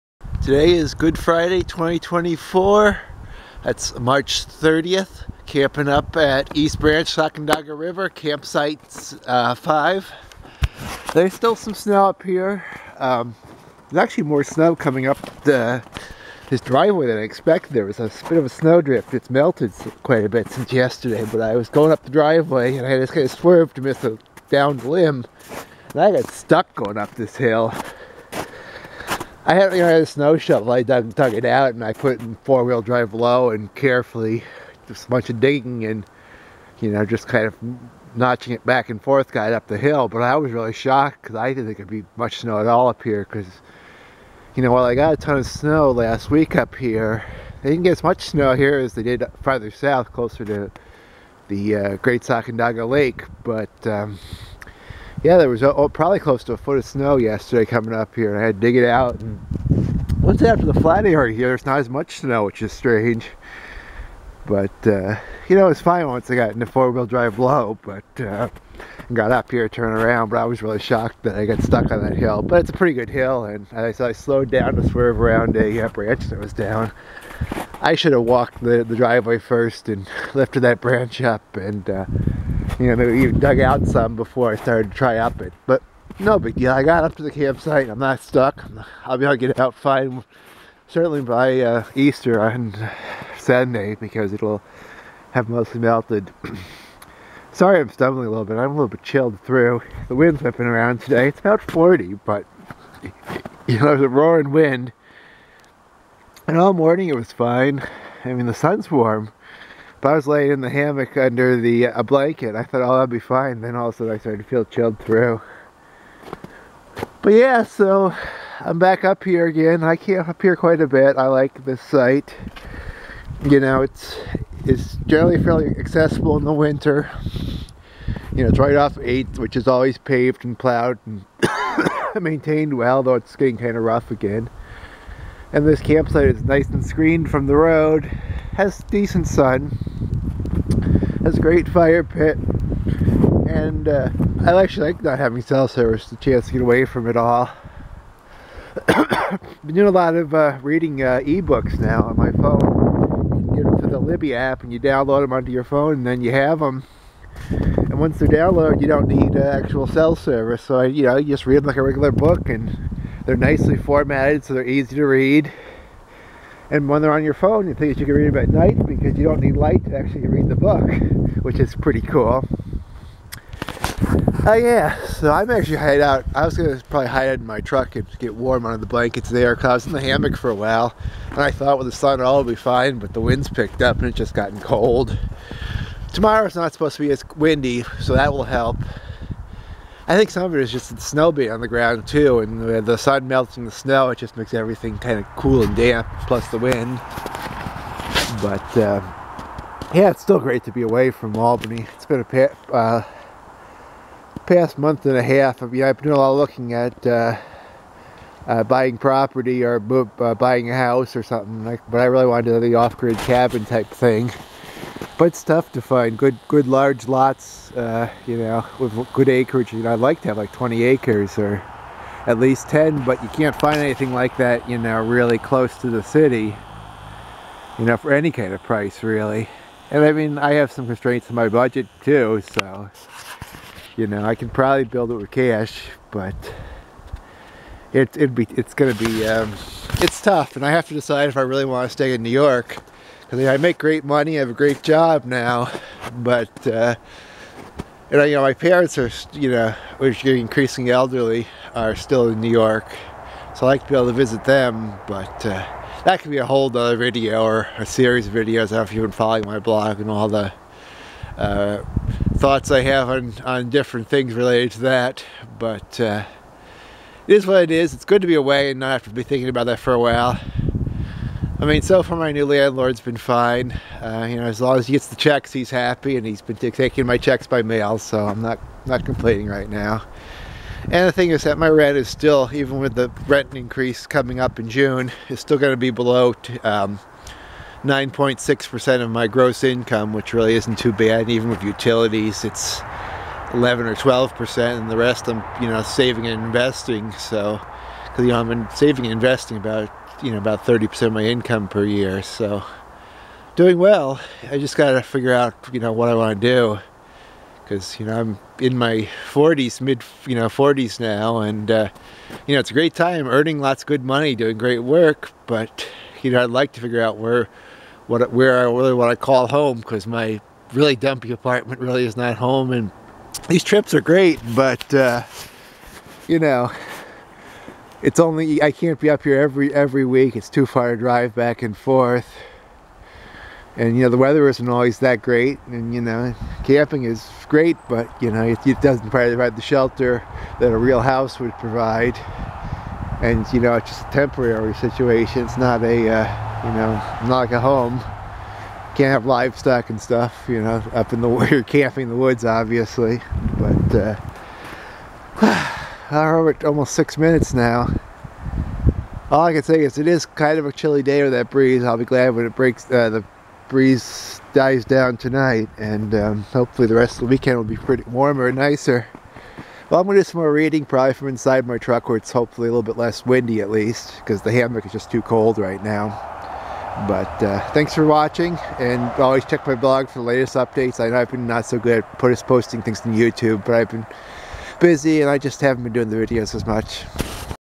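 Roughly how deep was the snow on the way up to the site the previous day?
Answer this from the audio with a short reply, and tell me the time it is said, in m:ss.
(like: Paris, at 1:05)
close to a foot, at 0:56.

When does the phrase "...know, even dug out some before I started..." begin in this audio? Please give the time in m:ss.
1:22.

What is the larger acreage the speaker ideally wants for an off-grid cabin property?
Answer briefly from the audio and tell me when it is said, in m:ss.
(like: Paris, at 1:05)
20 acres, at 3:40.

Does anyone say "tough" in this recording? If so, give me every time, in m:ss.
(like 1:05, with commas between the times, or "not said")
3:35, 4:00.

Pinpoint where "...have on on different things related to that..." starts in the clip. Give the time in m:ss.
4:22.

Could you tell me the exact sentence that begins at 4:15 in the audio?
But uh, that could be a whole other video or a series of videos.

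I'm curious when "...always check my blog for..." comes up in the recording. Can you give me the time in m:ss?
6:19.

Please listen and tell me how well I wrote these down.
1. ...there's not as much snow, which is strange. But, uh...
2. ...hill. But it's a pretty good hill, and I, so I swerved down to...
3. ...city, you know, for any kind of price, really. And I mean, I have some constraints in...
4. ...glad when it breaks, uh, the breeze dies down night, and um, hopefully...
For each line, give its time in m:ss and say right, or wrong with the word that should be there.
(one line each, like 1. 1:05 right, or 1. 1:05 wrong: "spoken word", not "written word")
1. 1:01 right
2. 1:12 wrong: "slowed", not "swerved"
3. 3:46 right
4. 6:02 wrong: "tonight", not "night".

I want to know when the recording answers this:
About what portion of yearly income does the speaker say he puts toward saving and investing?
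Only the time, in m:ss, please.
5:00.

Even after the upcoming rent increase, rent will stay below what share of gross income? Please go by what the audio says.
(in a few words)
9.6%.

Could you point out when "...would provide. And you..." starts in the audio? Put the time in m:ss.
5:41.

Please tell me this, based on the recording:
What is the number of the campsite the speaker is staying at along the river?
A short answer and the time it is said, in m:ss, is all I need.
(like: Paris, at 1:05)
5, at 0:09.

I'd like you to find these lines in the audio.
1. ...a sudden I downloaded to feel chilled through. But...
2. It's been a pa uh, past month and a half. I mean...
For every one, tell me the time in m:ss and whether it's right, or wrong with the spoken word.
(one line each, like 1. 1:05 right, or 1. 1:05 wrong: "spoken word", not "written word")
1. 1:53 wrong: "started", not "downloaded"
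2. 3:21 right.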